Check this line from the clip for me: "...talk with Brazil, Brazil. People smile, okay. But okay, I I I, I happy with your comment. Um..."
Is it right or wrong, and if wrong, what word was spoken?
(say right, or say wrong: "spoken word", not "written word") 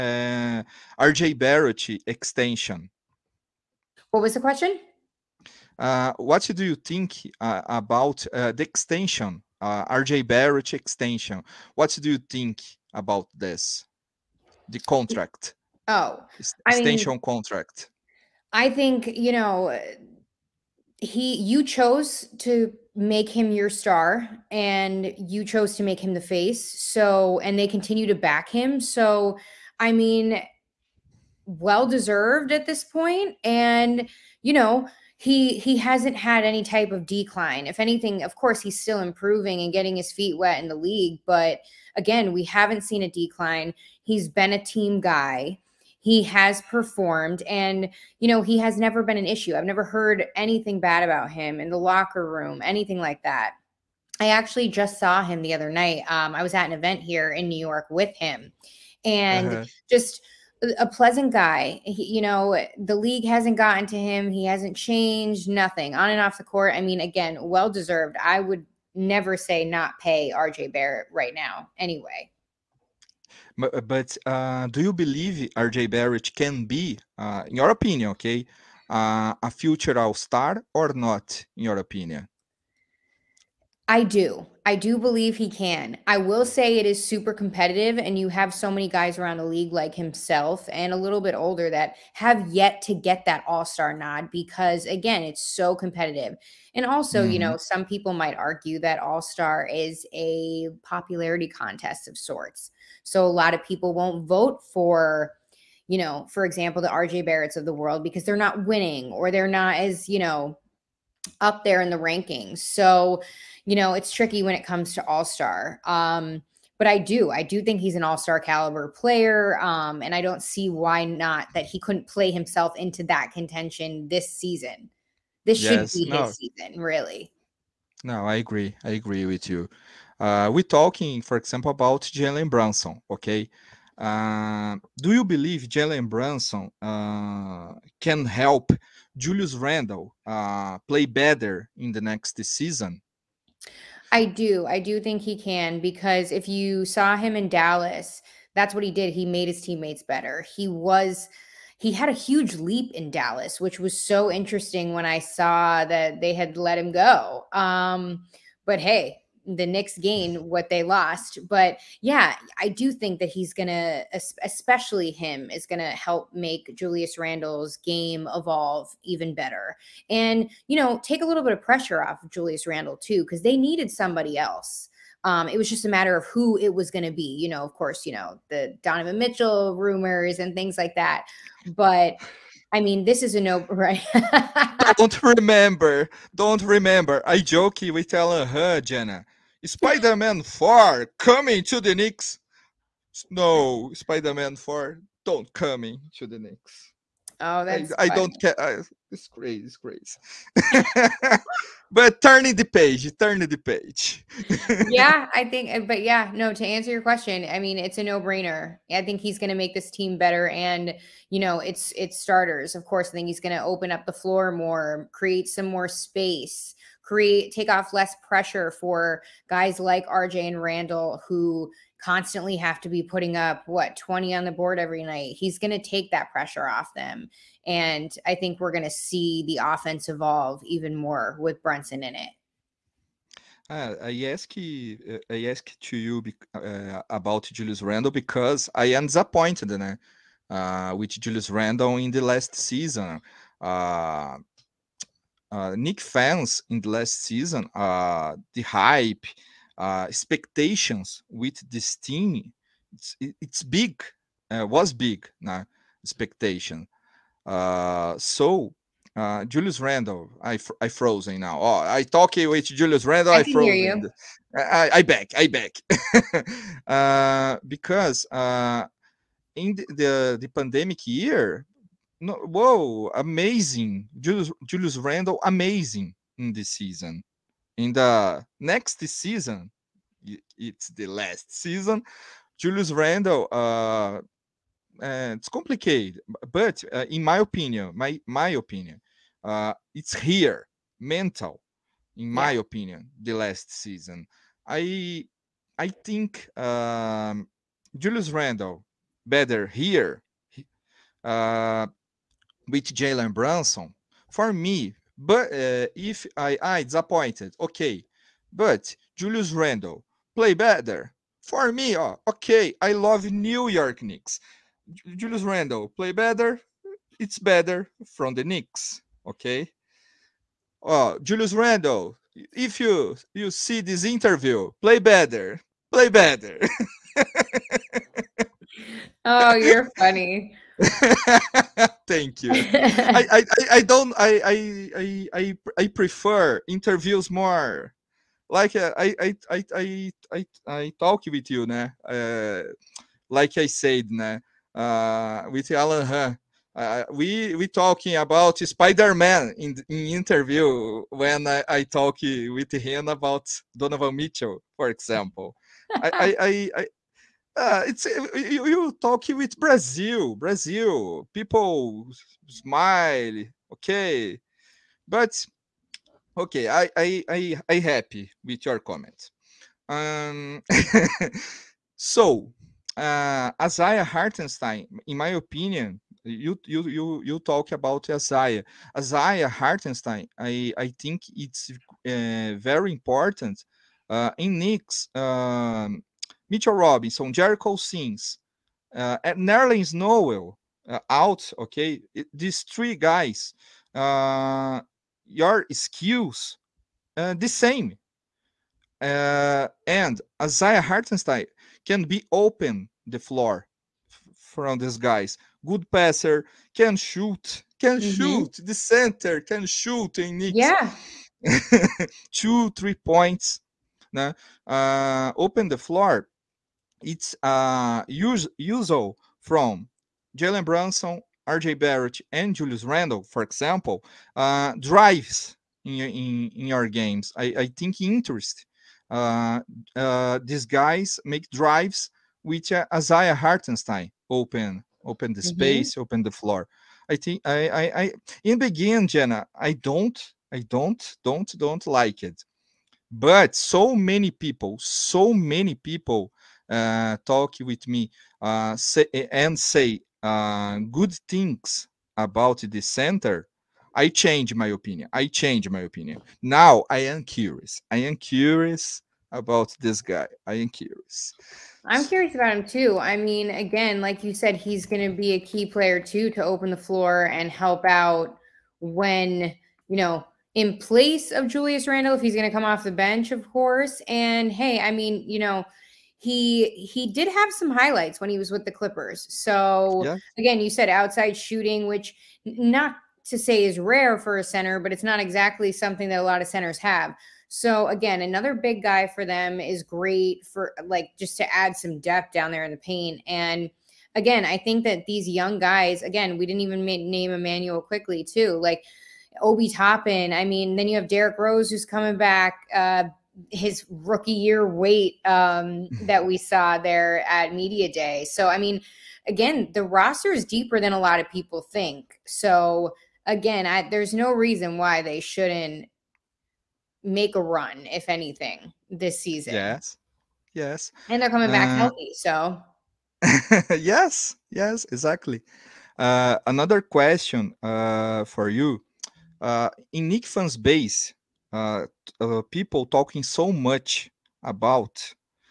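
right.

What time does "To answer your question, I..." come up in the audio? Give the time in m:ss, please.
3:26.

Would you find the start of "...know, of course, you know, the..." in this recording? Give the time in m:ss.
2:57.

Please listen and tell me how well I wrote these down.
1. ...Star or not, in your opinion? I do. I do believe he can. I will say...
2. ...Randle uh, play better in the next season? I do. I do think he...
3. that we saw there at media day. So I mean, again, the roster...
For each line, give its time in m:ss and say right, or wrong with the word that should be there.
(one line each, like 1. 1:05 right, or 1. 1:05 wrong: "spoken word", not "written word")
1. 1:20 right
2. 2:19 right
3. 8:26 right.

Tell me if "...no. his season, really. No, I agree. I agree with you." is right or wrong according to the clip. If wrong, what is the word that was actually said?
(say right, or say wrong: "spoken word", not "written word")
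right.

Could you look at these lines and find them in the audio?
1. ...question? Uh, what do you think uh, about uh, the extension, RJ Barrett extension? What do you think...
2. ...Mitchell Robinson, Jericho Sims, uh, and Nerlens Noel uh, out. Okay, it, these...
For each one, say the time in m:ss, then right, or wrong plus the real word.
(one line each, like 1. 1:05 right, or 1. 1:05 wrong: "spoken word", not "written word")
1. 0:04 right
2. 6:26 right.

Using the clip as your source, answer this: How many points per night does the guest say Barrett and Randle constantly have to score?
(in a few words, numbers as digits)
20.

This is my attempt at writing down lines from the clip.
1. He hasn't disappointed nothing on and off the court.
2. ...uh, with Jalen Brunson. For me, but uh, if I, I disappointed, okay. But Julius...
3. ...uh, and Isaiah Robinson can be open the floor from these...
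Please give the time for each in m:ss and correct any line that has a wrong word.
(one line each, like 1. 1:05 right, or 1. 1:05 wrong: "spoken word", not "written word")
1. 1:04 wrong: "changed", not "disappointed"
2. 5:01 right
3. 6:38 wrong: "Hartenstein", not "Robinson".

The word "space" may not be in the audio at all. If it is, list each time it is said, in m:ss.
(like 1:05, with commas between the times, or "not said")
3:35, 7:15.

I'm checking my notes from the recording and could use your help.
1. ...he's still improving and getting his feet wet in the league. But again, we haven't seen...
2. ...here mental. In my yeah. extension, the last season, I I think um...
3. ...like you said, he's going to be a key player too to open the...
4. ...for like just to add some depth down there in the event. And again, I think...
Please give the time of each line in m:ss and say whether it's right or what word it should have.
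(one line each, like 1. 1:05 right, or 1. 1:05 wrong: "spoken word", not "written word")
1. 0:38 right
2. 4:50 wrong: "opinion", not "extension"
3. 7:43 right
4. 8:10 wrong: "paint", not "event".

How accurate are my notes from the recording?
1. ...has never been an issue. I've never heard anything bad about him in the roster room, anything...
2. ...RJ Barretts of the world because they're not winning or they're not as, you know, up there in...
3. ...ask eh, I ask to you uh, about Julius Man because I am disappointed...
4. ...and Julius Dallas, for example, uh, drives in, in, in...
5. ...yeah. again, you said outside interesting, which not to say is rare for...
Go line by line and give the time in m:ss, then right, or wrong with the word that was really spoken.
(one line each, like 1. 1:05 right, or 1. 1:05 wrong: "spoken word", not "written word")
1. 0:48 wrong: "locker", not "roster"
2. 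1:46 right
3. 3:54 wrong: "Randle", not "Man"
4. 7:02 wrong: "Randle", not "Dallas"
5. 8:00 wrong: "shooting", not "interesting".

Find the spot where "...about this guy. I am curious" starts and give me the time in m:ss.
7:39.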